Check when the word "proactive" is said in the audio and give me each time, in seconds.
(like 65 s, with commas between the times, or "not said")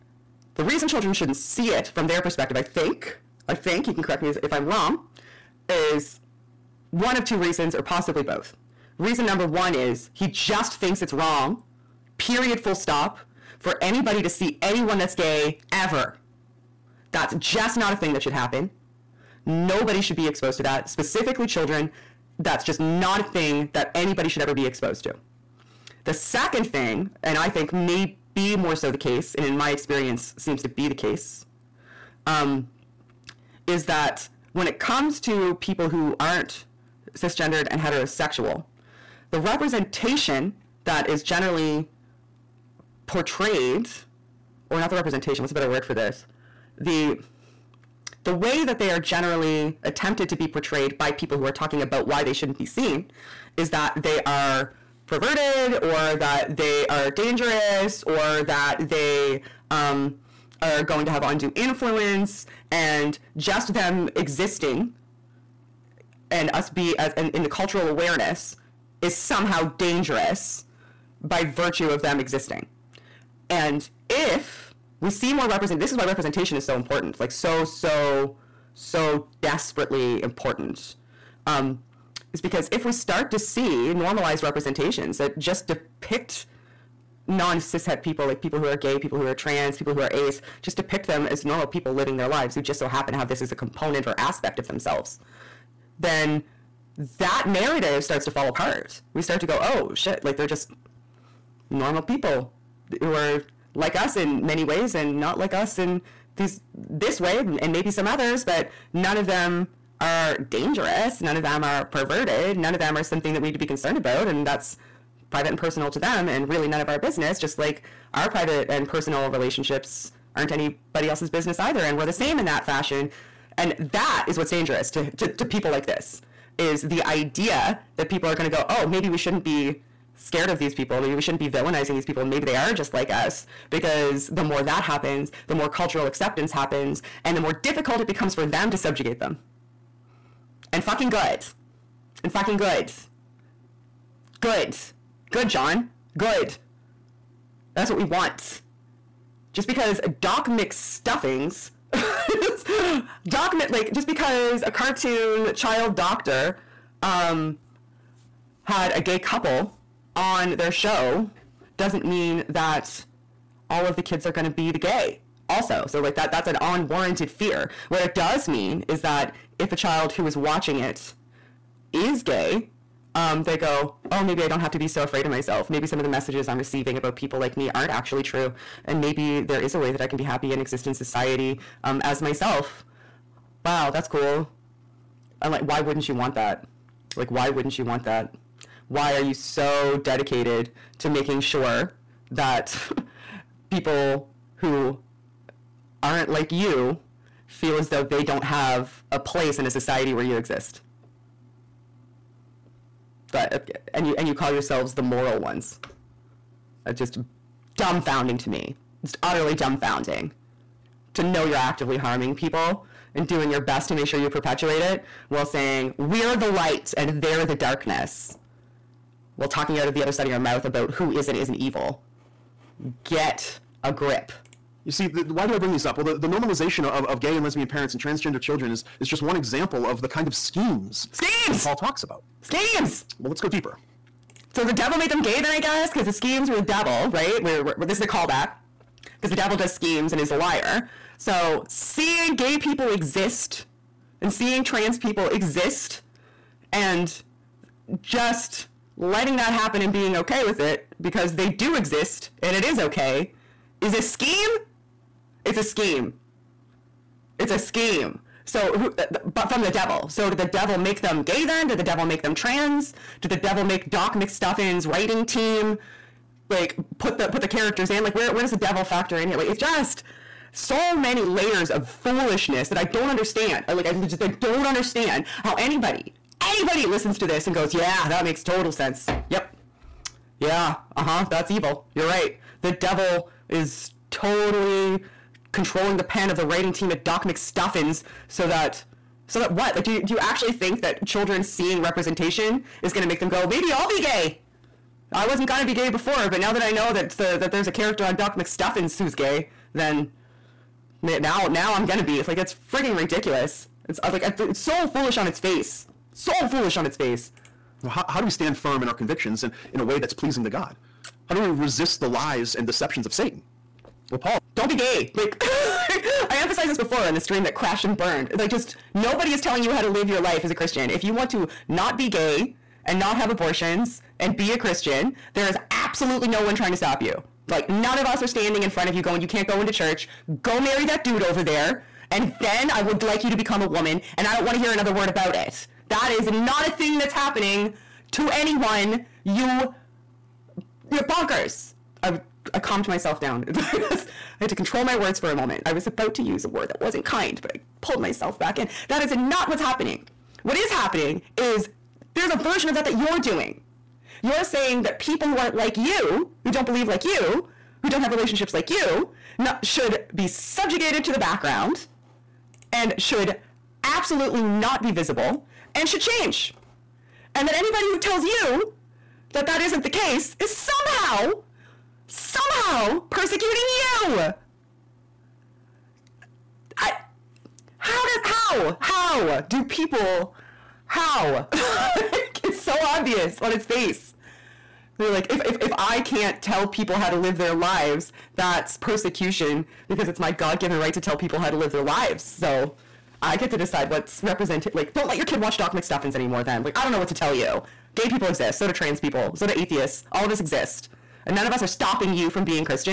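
not said.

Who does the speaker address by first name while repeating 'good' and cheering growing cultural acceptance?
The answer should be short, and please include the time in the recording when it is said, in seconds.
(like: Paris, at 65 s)
Jon, at 145 s.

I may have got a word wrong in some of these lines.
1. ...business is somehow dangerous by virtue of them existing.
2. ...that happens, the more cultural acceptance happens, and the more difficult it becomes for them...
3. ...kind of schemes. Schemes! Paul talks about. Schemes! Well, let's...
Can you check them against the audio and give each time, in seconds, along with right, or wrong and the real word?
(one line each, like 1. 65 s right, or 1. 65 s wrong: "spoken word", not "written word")
1. 67 s wrong: "awareness", not "business"
2. 134 s right
3. 230 s right.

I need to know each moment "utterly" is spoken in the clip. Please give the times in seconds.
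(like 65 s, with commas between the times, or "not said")
209 s.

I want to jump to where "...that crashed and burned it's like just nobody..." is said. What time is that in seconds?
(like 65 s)
317 s.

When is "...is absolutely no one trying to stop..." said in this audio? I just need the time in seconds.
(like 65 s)
325 s.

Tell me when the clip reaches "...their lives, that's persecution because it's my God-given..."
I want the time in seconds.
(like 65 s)
387 s.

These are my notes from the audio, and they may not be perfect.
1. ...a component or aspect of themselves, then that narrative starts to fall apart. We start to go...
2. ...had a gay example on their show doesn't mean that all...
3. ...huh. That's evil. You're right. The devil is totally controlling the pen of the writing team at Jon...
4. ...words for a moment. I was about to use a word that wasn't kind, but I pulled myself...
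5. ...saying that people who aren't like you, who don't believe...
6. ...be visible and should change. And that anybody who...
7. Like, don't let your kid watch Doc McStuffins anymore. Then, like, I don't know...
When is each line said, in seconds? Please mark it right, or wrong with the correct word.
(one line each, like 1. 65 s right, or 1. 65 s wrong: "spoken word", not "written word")
1. 93 s right
2. 158 s wrong: "couple", not "example"
3. 281 s wrong: "Doc", not "Jon"
4. 344 s right
5. 354 s right
6. 364 s right
7. 394 s right.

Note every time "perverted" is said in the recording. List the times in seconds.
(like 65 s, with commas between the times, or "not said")
55 s, 111 s.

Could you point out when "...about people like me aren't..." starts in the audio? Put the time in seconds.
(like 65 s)
176 s.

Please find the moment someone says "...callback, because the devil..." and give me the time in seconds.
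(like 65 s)
238 s.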